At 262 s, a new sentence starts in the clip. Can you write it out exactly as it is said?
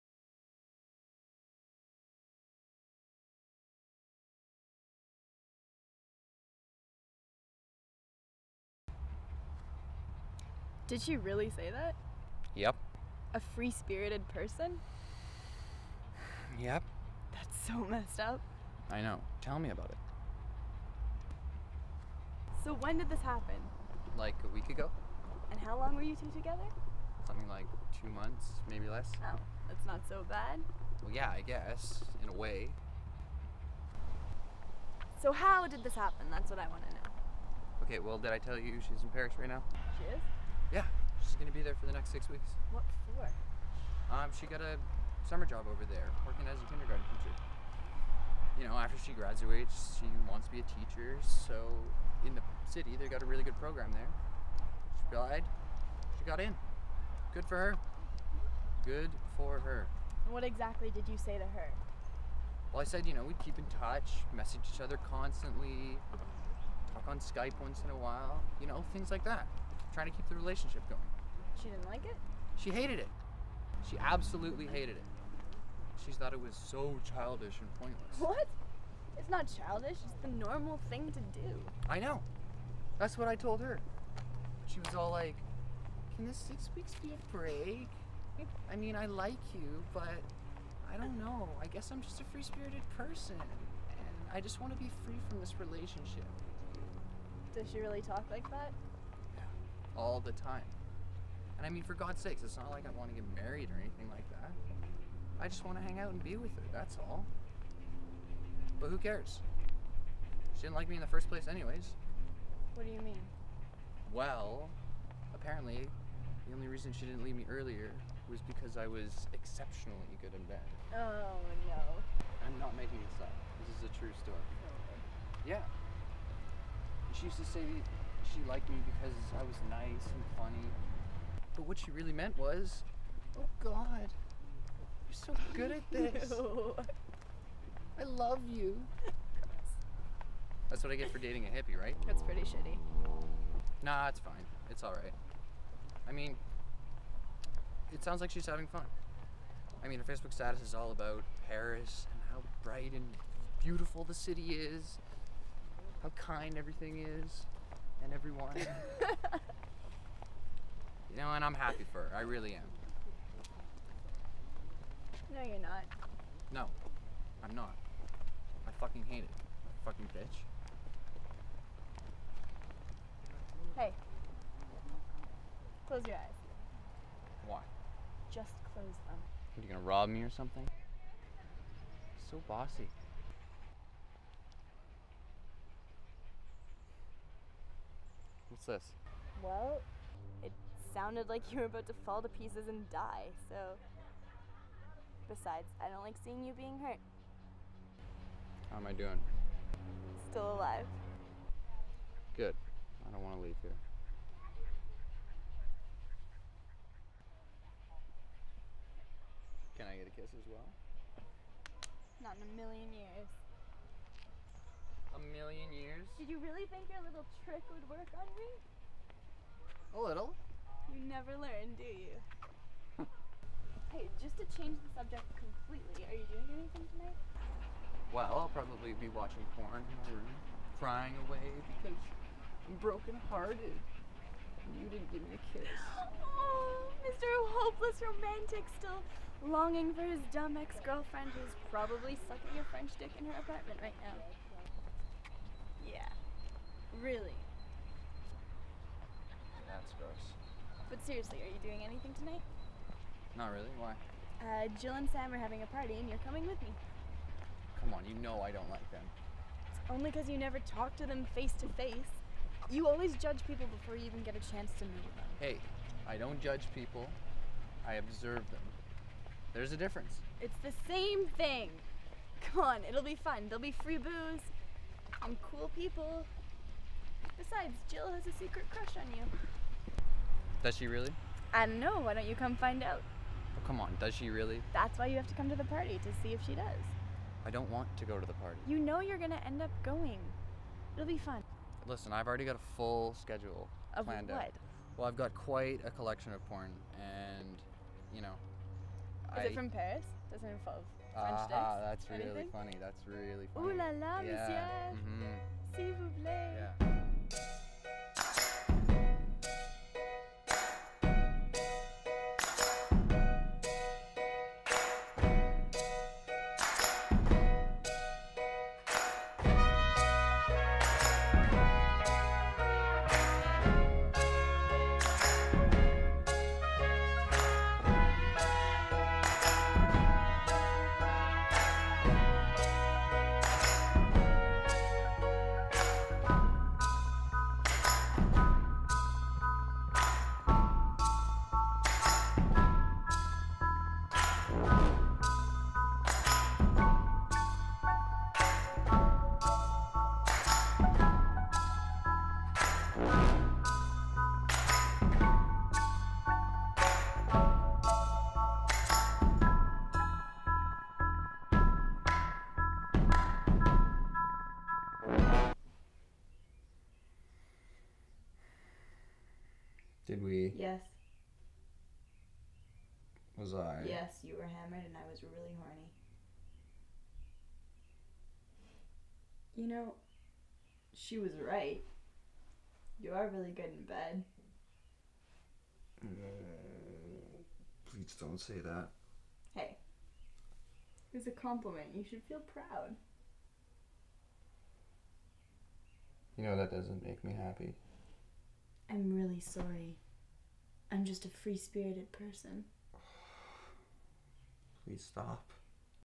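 You always judge people before you even get a chance to meet them.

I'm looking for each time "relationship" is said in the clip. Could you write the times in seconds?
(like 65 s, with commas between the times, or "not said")
70 s, 95 s.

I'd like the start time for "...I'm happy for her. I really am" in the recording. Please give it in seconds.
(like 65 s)
161 s.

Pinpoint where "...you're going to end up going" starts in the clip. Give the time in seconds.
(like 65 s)
289 s.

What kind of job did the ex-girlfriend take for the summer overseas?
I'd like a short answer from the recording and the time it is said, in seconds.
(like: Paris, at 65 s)
Kindergarten teacher, at 46 s.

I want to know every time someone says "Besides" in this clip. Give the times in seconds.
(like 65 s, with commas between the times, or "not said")
195 s, 277 s.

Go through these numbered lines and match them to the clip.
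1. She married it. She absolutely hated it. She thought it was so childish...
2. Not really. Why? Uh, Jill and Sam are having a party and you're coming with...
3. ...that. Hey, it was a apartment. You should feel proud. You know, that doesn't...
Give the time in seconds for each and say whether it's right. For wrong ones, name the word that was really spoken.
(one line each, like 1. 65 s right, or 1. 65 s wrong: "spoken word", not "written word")
1. 72 s wrong: "hated", not "married"
2. 253 s right
3. 388 s wrong: "compliment", not "apartment".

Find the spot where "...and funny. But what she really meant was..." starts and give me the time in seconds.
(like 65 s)
130 s.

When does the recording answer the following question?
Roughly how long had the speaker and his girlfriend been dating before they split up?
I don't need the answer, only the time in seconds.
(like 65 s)
28 s.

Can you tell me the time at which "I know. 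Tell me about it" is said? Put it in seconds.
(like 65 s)
18 s.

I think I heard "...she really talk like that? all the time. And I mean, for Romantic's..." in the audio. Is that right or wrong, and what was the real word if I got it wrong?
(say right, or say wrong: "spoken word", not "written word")
wrong: "God", not "Romantic".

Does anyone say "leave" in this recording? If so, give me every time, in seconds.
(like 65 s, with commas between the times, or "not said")
117 s, 203 s.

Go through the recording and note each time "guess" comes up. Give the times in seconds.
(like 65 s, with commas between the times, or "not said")
31 s, 91 s.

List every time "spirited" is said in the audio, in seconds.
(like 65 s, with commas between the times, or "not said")
13 s, 92 s, 401 s.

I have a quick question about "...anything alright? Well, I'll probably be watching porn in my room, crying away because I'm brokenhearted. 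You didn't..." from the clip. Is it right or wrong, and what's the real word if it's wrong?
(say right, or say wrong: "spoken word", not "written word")
wrong: "tonight", not "alright".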